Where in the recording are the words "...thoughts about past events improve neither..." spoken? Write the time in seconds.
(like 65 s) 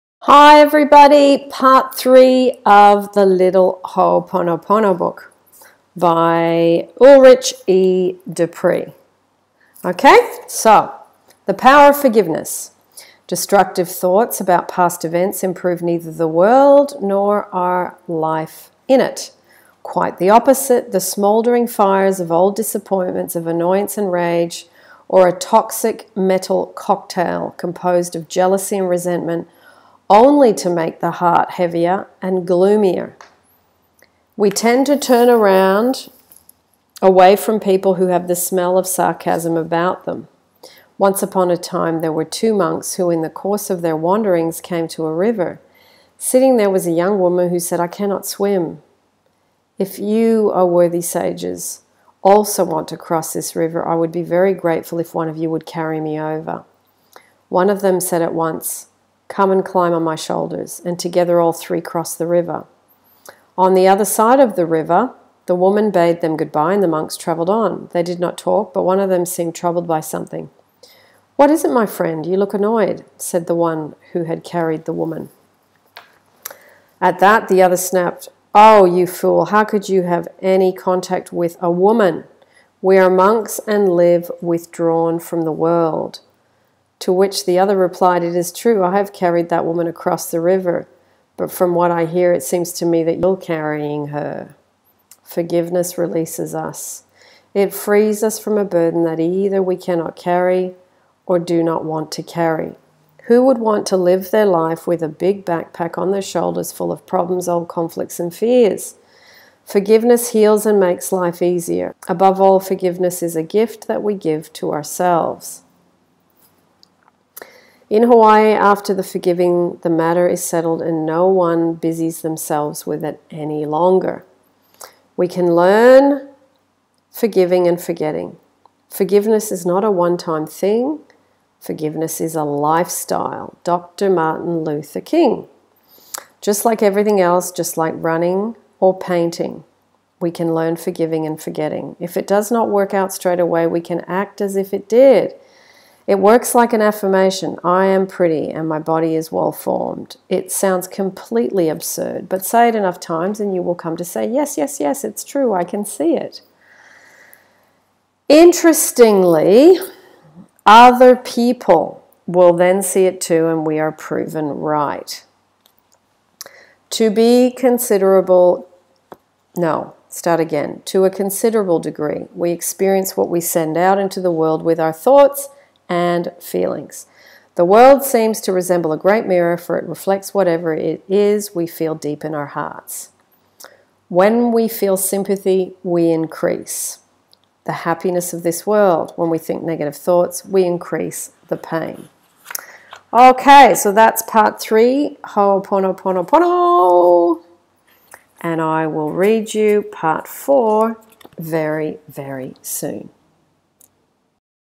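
13 s.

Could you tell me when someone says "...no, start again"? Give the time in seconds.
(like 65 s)
169 s.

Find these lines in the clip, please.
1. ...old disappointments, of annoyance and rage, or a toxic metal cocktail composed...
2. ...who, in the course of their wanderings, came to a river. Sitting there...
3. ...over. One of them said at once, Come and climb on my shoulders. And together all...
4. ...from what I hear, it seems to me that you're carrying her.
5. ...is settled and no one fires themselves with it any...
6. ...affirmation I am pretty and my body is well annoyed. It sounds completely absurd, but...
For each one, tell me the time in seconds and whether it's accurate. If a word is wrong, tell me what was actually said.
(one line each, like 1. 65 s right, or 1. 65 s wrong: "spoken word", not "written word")
1. 22 s right
2. 42 s right
3. 56 s right
4. 91 s right
5. 120 s wrong: "busies", not "fires"
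6. 146 s wrong: "formed", not "annoyed".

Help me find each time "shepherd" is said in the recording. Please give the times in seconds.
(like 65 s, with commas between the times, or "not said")
not said.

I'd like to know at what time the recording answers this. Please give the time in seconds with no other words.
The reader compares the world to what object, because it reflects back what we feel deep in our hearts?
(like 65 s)
178 s.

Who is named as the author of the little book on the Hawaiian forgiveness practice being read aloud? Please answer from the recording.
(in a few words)
Ulrich E. Dupree.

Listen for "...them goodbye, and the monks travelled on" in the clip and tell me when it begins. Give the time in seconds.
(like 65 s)
66 s.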